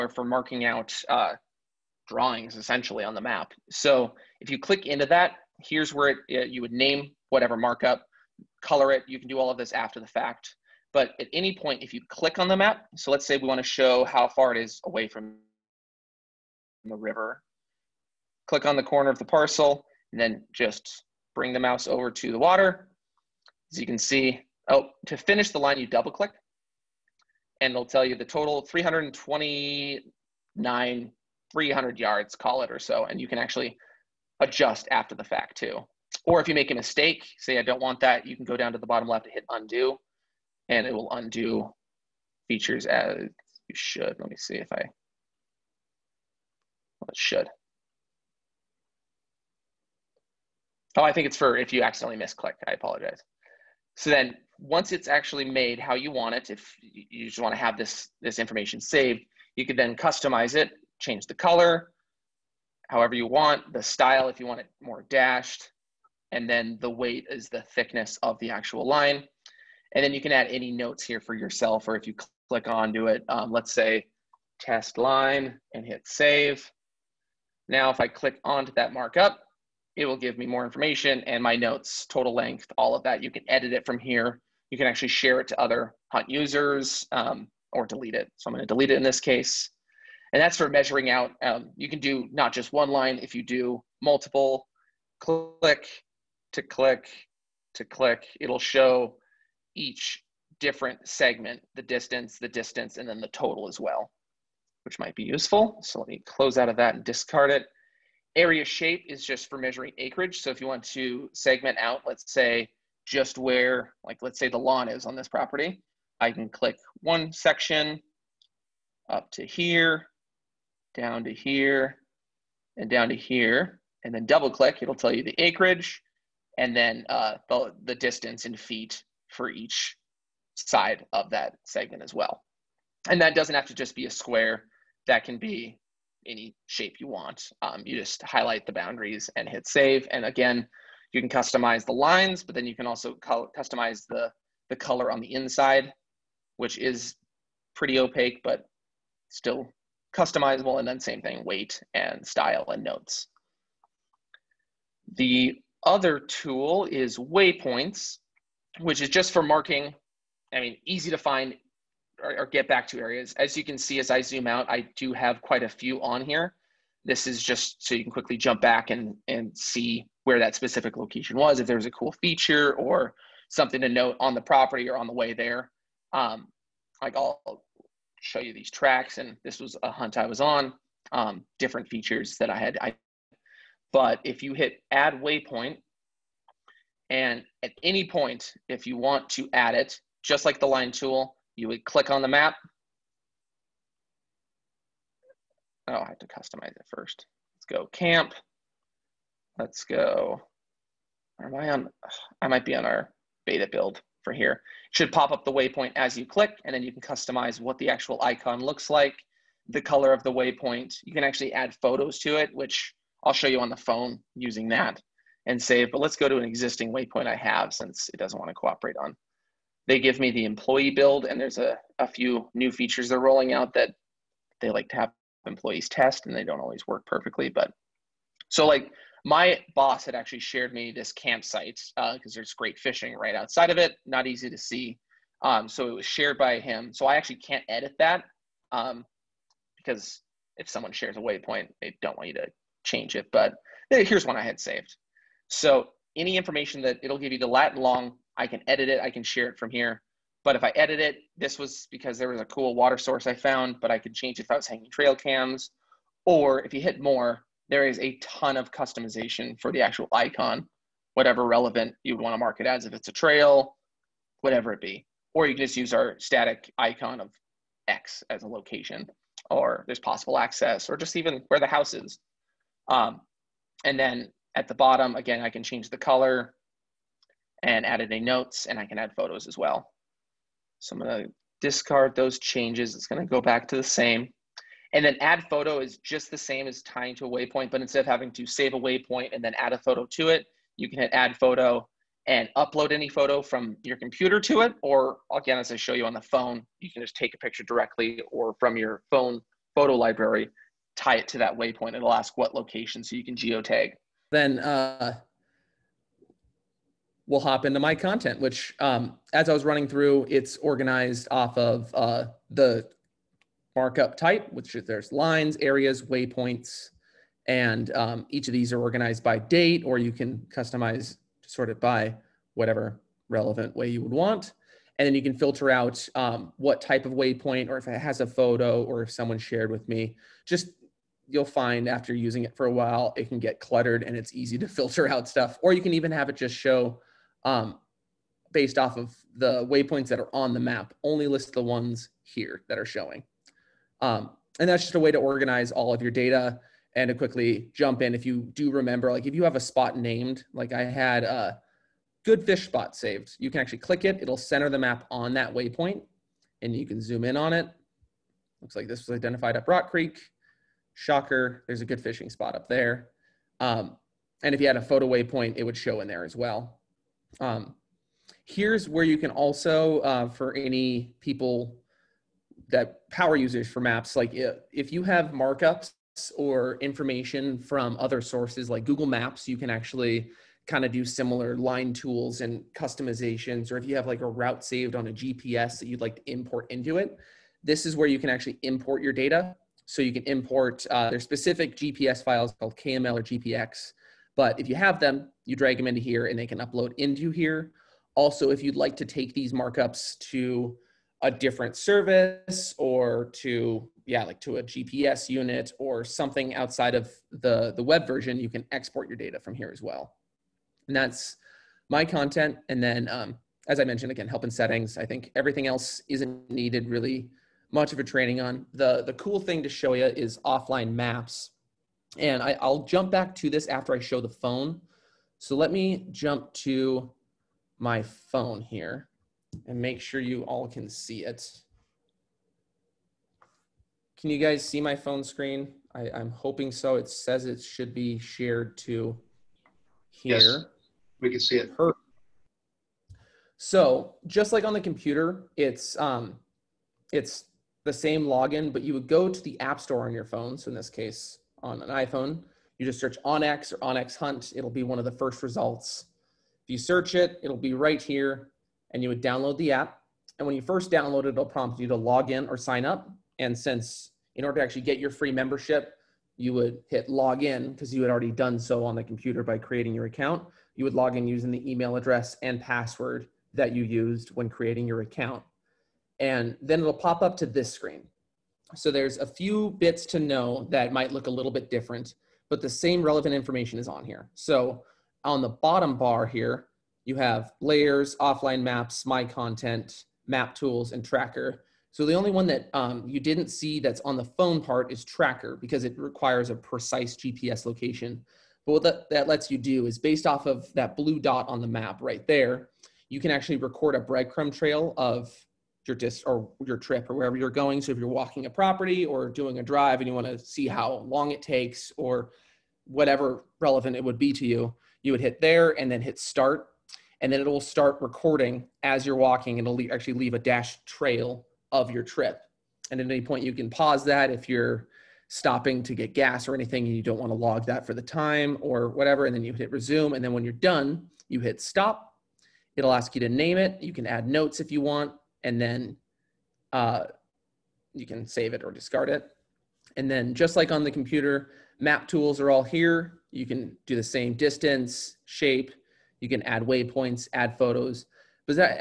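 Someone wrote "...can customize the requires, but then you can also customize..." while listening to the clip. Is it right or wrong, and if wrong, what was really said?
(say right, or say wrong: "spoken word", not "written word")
wrong: "lines", not "requires".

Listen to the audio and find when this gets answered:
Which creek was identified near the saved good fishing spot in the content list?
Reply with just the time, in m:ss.
5:59.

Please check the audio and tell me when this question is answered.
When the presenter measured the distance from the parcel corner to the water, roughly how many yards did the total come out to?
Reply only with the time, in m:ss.
0:31.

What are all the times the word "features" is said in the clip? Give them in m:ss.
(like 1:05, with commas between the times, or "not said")
0:42, 2:52, 3:01, 3:42.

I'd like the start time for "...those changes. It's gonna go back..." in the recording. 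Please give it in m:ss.
4:42.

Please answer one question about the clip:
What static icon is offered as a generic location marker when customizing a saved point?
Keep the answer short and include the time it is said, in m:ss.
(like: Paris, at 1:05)
X, at 4:27.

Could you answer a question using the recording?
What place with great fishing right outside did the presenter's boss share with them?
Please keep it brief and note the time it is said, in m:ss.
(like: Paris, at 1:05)
campsite, at 3:51.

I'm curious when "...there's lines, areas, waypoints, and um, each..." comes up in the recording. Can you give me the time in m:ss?
5:14.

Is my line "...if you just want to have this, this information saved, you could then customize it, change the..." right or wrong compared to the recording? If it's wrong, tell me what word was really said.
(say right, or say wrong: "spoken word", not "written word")
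right.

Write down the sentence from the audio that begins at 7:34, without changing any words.
It'll be one of the first results.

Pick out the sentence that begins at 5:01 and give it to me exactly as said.
It'll ask what location so you can geotag.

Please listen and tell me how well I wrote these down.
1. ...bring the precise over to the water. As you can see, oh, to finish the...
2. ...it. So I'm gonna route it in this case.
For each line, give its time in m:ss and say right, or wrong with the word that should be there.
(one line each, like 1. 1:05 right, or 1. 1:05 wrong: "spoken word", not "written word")
1. 0:21 wrong: "mouse", not "precise"
2. 1:28 wrong: "delete", not "route".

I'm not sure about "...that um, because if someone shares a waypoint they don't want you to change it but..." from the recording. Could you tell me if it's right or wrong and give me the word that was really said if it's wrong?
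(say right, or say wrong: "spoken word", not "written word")
right.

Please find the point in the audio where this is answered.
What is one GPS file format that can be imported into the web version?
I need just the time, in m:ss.
6:32.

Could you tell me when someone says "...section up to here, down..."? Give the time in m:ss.
1:57.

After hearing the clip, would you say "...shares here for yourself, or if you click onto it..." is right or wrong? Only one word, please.
wrong.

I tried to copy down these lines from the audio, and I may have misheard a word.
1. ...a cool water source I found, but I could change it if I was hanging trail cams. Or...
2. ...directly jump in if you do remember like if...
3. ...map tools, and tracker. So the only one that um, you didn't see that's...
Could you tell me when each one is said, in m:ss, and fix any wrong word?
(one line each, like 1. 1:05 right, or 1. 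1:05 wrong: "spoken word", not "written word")
1. 4:12 right
2. 5:47 wrong: "quickly", not "directly"
3. 8:10 right.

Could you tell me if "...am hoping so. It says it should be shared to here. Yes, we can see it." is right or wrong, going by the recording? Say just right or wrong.
right.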